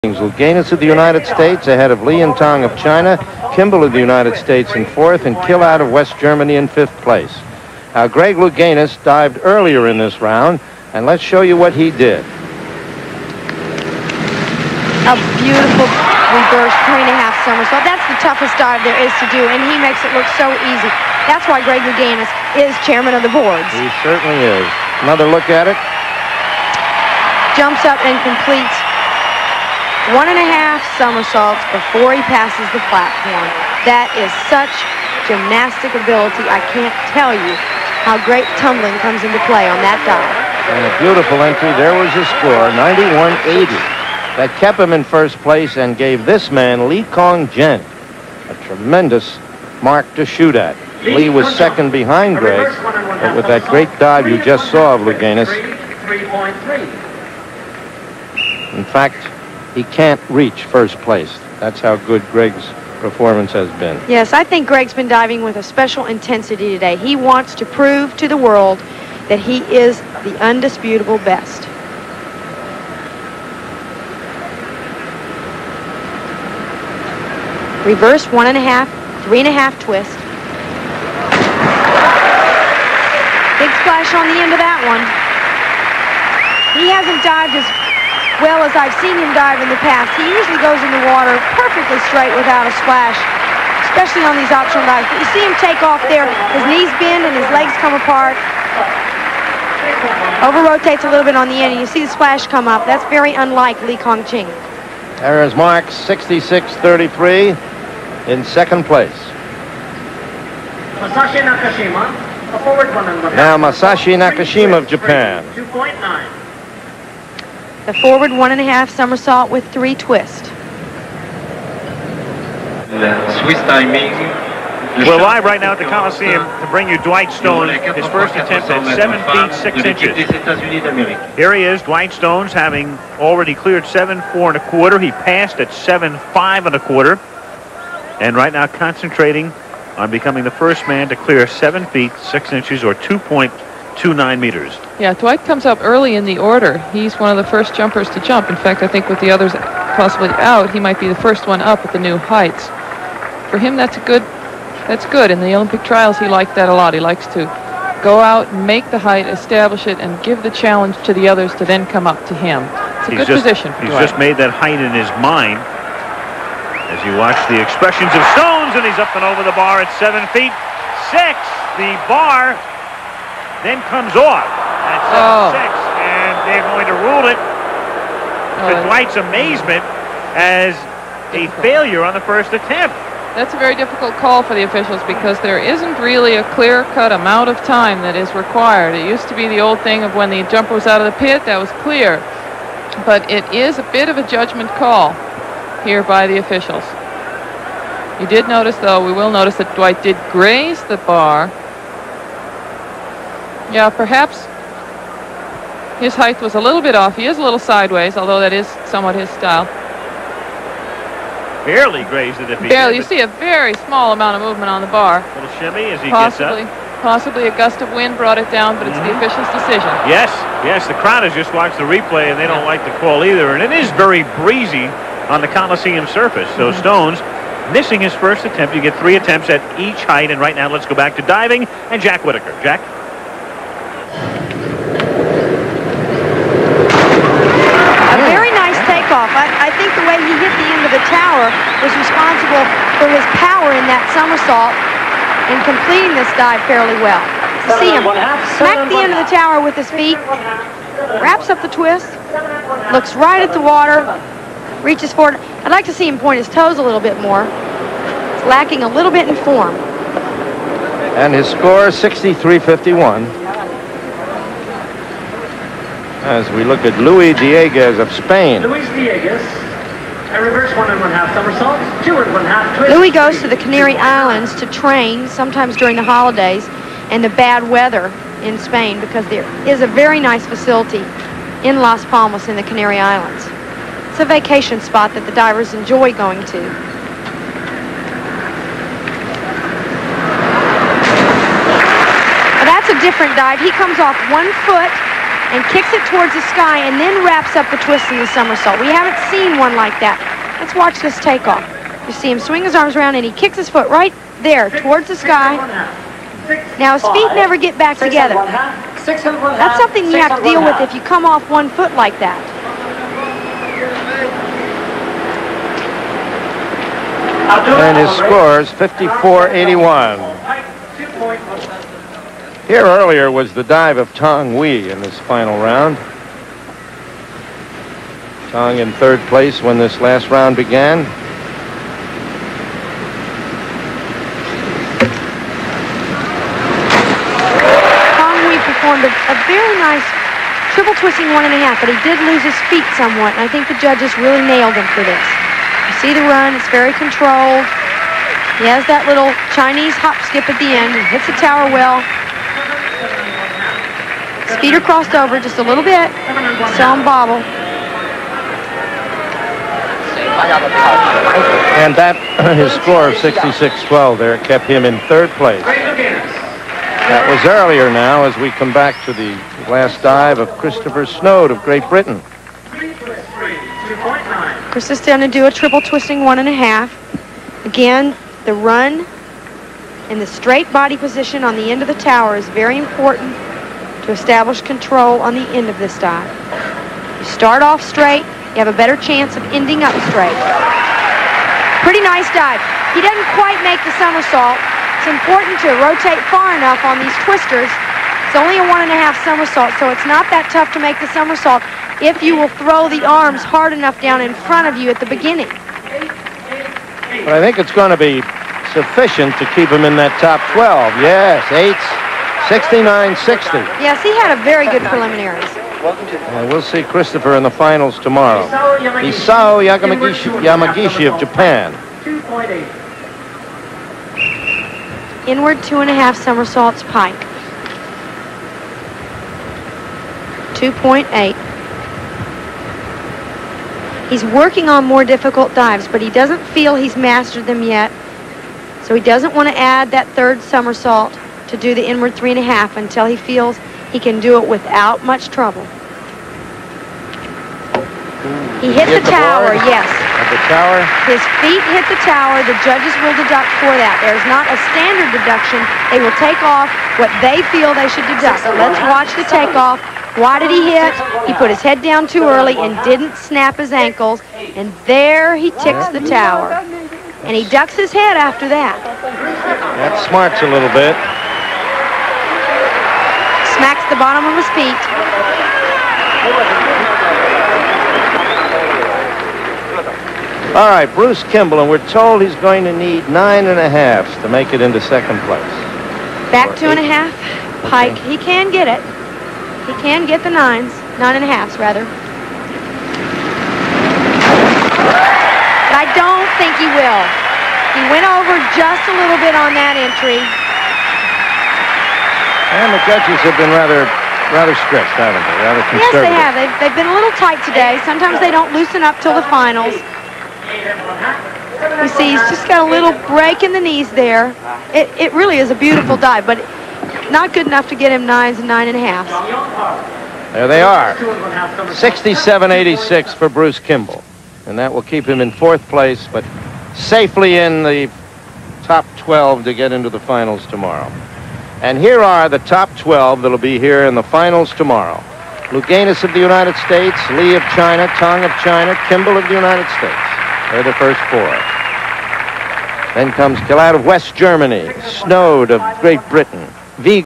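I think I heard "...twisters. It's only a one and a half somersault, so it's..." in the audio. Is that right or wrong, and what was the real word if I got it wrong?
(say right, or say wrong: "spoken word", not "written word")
right.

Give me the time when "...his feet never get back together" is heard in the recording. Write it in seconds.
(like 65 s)
306 s.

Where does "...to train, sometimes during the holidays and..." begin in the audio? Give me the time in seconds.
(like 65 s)
274 s.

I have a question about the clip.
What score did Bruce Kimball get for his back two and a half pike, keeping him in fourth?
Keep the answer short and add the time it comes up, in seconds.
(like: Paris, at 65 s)
67.86, at 520 s.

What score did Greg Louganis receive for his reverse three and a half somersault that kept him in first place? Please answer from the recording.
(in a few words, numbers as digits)
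91.80.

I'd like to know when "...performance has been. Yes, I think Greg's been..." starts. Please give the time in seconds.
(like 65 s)
62 s.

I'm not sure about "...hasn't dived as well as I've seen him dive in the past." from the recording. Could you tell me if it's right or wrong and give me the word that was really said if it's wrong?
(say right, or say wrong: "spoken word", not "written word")
right.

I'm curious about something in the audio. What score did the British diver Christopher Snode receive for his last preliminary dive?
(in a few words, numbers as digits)
69.60.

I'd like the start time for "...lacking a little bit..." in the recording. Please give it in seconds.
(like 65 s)
258 s.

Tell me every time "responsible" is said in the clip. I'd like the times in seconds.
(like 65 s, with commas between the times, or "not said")
241 s.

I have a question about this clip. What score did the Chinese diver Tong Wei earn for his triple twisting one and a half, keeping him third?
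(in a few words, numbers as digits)
66.12.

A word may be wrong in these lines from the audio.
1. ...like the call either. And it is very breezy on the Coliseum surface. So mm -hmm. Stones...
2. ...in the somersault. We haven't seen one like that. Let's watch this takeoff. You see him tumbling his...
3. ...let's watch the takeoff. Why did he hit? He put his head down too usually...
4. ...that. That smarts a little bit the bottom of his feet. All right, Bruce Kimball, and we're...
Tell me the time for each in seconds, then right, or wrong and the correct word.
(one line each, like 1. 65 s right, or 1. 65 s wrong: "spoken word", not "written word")
1. 222 s right
2. 298 s wrong: "swing", not "tumbling"
3. 458 s wrong: "early", not "usually"
4. 468 s right.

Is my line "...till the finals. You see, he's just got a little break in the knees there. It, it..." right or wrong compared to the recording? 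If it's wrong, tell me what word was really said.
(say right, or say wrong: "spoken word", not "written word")
right.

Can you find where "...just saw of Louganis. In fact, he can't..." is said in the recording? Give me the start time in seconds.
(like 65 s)
54 s.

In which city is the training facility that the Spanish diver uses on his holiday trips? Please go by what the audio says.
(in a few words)
Las Palmas.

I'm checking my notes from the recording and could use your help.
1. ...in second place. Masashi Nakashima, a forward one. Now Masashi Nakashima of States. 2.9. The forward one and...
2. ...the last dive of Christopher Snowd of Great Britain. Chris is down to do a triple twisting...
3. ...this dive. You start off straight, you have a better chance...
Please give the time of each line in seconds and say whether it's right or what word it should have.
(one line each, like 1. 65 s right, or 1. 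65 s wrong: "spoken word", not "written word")
1. 108 s wrong: "Japan", not "States"
2. 369 s right
3. 385 s right.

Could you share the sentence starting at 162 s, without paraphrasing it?
It's a he's good just, position.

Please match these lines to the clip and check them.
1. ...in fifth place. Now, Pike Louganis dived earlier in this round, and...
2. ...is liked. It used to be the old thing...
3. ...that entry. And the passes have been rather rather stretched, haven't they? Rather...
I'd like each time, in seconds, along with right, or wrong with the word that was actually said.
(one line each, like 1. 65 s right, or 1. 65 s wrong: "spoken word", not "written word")
1. 6 s wrong: "Greg", not "Pike"
2. 188 s wrong: "required", not "liked"
3. 499 s wrong: "judges", not "passes".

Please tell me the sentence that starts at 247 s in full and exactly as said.
See him smack the end of the tower with his feet, wraps up the twist, looks right at the water, reaches forward.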